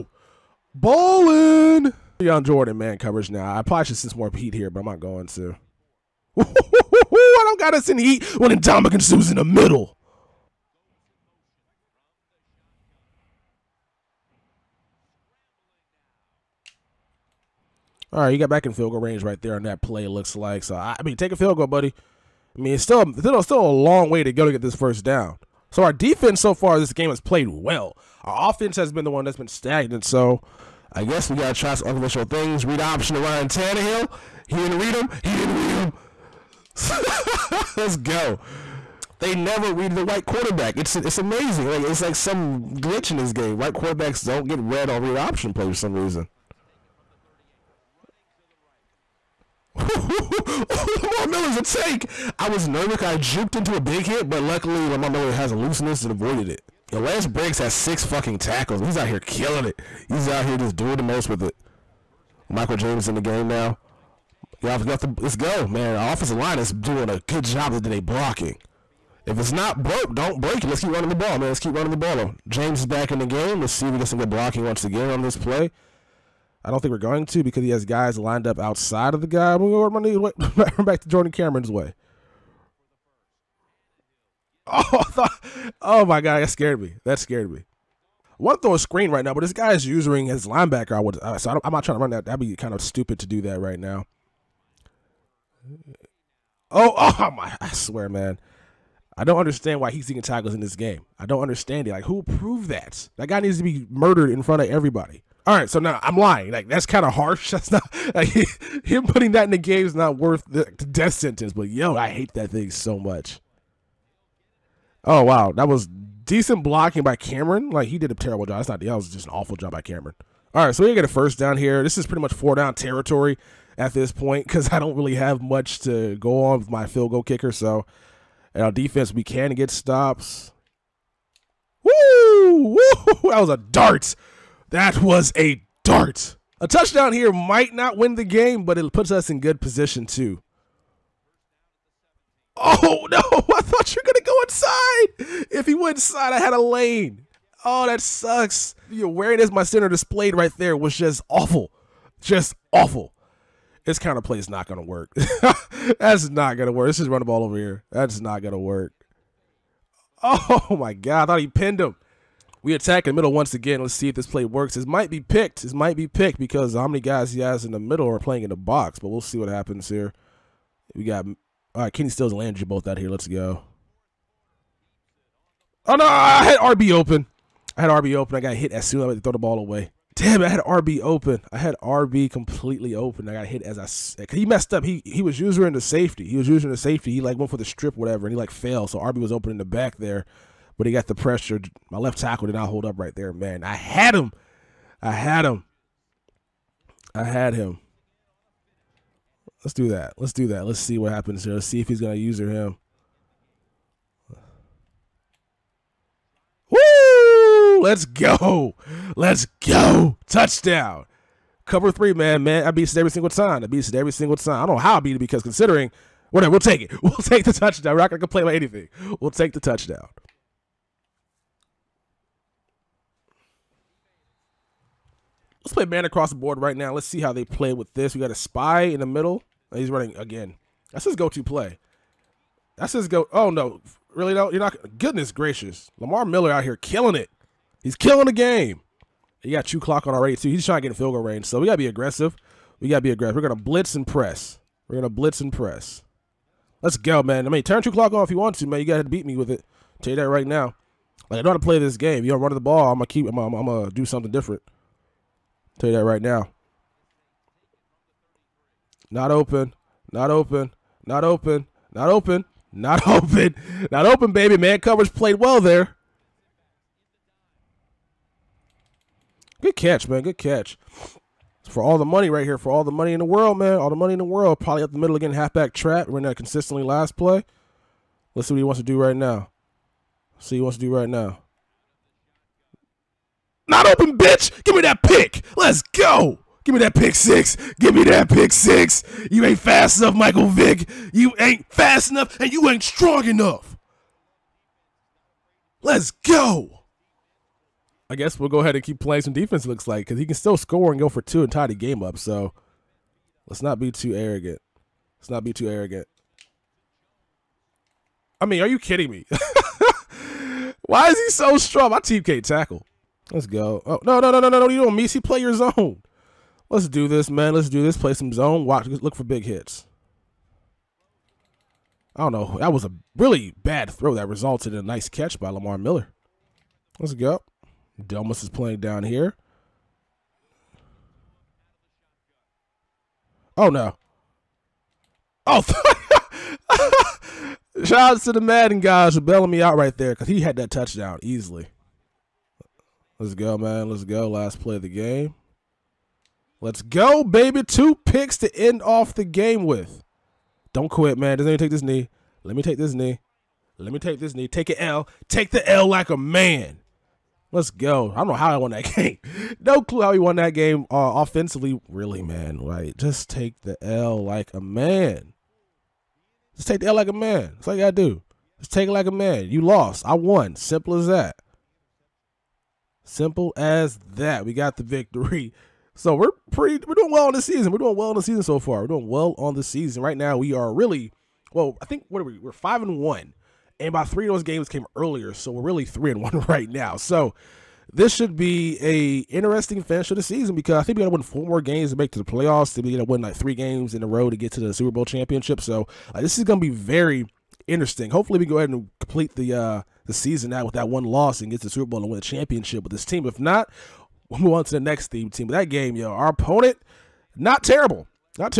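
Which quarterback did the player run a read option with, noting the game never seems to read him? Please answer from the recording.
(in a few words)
Ryan Tannehill.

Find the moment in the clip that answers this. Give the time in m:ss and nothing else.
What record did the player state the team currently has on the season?
6:22.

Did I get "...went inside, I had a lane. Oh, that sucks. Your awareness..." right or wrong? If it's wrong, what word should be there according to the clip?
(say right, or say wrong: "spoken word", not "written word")
right.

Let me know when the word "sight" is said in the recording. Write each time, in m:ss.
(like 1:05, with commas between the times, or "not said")
not said.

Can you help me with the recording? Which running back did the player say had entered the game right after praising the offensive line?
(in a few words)
Michael James.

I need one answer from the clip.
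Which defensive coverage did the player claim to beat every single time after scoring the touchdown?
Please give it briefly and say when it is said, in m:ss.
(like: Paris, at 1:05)
Cover 3, at 3:31.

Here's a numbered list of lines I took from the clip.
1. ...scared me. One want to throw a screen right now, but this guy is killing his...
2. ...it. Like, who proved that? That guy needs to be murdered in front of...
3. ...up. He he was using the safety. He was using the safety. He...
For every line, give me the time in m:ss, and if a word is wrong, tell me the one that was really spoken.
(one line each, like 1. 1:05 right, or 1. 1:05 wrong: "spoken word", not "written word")
1. 1:27 wrong: "using", not "killing"
2. 1:41 right
3. 3:04 right.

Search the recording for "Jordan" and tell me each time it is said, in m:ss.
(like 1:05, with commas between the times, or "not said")
0:02, 1:21.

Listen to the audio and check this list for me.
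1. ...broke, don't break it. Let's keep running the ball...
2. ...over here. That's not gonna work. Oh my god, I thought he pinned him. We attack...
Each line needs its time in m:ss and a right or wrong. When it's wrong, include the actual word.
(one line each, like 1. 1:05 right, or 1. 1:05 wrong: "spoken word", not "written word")
1. 1:09 right
2. 2:37 right.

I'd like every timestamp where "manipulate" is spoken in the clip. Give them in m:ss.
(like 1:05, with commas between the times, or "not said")
not said.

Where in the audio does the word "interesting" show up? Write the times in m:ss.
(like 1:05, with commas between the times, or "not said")
6:29, 6:37.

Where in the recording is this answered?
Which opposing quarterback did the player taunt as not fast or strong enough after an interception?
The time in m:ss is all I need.
4:50.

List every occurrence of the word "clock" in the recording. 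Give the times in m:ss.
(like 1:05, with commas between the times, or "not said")
3:59, 4:07.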